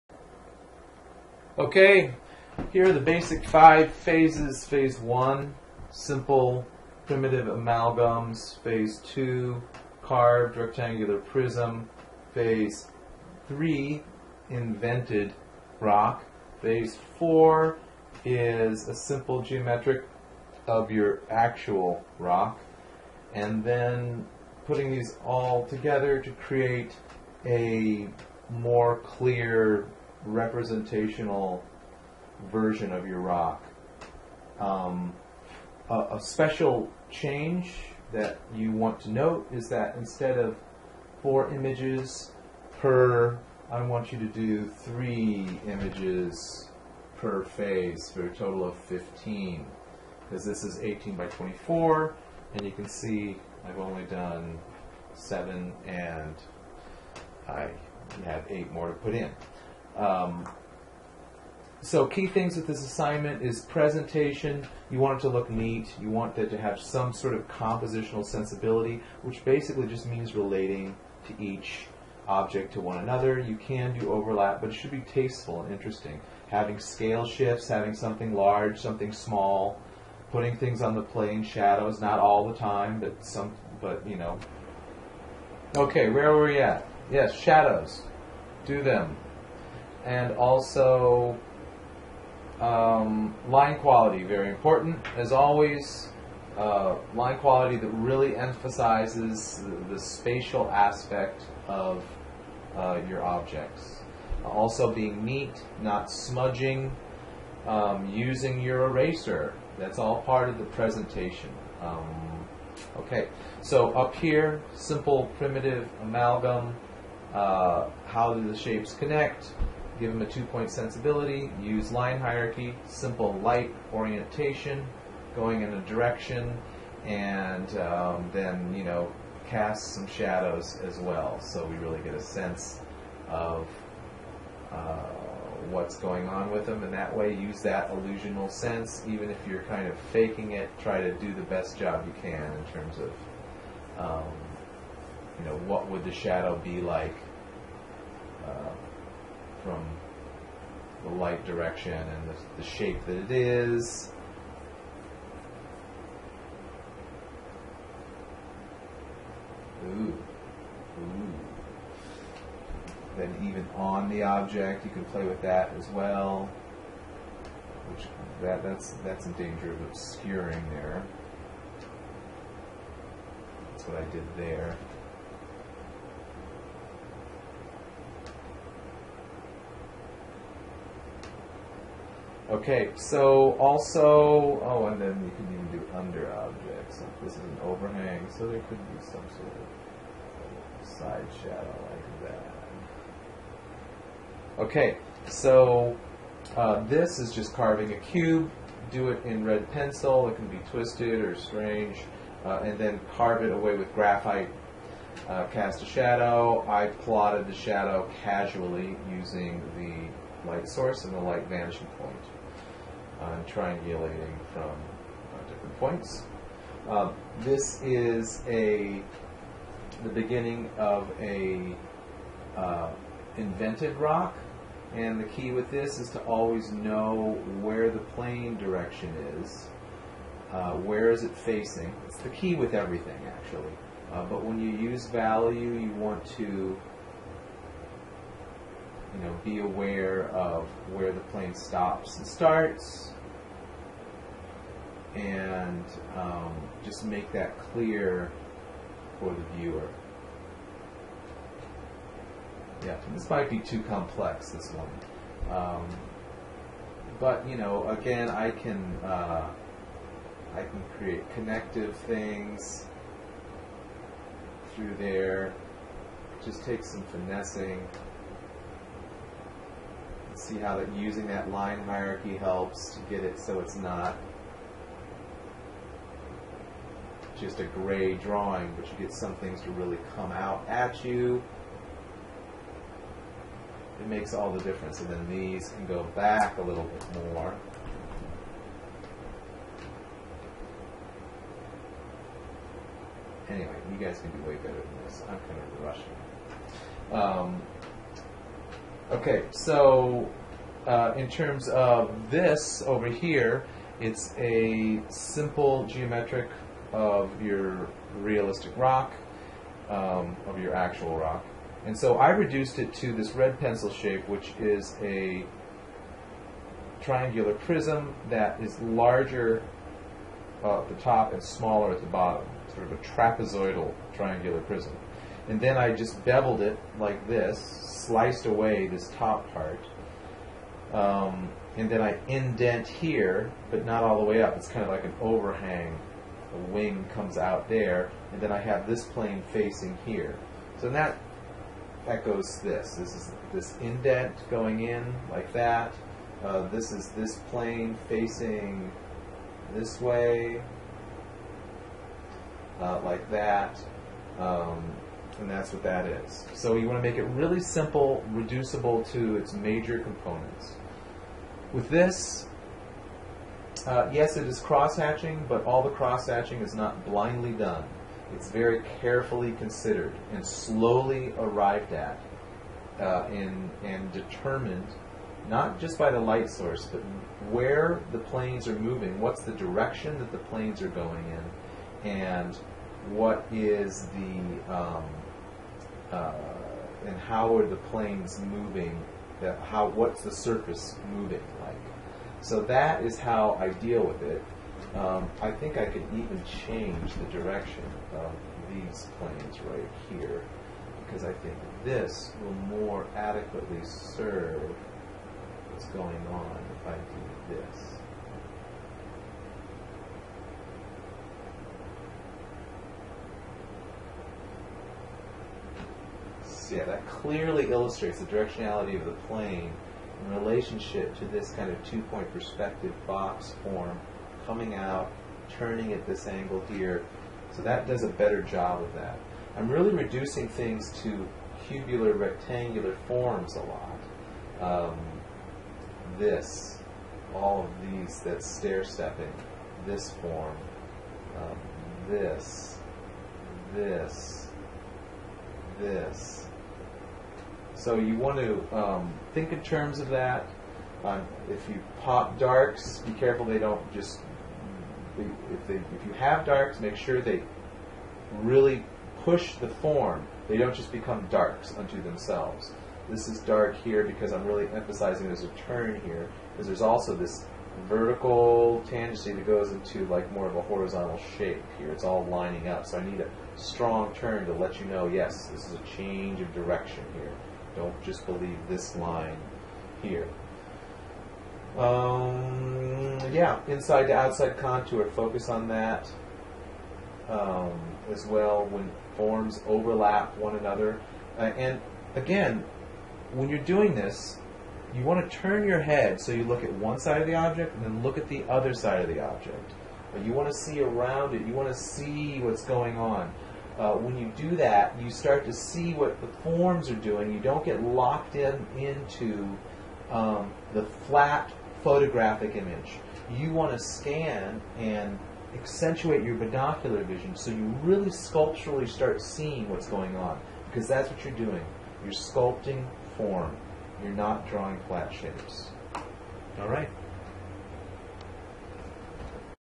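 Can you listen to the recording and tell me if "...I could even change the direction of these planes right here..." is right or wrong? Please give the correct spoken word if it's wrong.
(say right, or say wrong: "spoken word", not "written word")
right.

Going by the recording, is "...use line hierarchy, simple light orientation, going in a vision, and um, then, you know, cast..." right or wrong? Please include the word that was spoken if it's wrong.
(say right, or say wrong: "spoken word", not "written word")
wrong: "direction", not "vision".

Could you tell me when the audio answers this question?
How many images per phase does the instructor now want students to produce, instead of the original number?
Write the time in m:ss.
0:44.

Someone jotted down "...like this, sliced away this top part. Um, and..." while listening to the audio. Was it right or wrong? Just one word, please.
right.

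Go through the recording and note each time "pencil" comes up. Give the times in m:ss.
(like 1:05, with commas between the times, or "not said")
3:19, 5:13.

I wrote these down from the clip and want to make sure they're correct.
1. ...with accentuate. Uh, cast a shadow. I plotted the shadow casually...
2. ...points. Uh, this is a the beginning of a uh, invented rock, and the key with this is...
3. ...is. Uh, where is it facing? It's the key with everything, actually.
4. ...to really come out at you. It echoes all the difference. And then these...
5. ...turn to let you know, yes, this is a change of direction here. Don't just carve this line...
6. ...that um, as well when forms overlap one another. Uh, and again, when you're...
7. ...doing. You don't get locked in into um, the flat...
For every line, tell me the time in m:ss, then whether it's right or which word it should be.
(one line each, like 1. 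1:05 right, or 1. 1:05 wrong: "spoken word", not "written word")
1. 3:23 wrong: "graphite", not "accentuate"
2. 3:35 right
3. 3:49 right
4. 4:39 wrong: "makes", not "echoes"
5. 7:54 wrong: "believe", not "carve"
6. 8:05 right
7. 8:26 right.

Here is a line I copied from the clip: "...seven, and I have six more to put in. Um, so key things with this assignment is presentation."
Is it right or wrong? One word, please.
wrong.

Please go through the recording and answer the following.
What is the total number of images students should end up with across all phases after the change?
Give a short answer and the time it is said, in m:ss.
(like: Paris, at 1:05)
15, at 0:48.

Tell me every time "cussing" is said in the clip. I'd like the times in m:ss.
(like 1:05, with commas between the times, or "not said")
not said.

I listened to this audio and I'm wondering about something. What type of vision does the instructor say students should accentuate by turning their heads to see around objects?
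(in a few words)
binocular vision.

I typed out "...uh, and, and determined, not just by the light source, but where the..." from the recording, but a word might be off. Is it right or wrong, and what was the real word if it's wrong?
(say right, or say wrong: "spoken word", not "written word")
right.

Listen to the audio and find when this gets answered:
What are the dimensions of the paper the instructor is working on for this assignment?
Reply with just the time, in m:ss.
0:50.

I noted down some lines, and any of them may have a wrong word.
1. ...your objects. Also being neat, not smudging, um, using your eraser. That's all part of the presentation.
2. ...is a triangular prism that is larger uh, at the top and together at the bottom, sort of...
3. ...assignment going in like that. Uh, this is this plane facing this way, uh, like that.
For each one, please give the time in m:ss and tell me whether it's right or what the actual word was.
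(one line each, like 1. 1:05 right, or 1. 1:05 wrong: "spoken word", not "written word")
1. 1:43 right
2. 5:14 wrong: "smaller", not "together"
3. 5:43 wrong: "indent", not "assignment".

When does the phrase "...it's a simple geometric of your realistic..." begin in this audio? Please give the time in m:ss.
5:03.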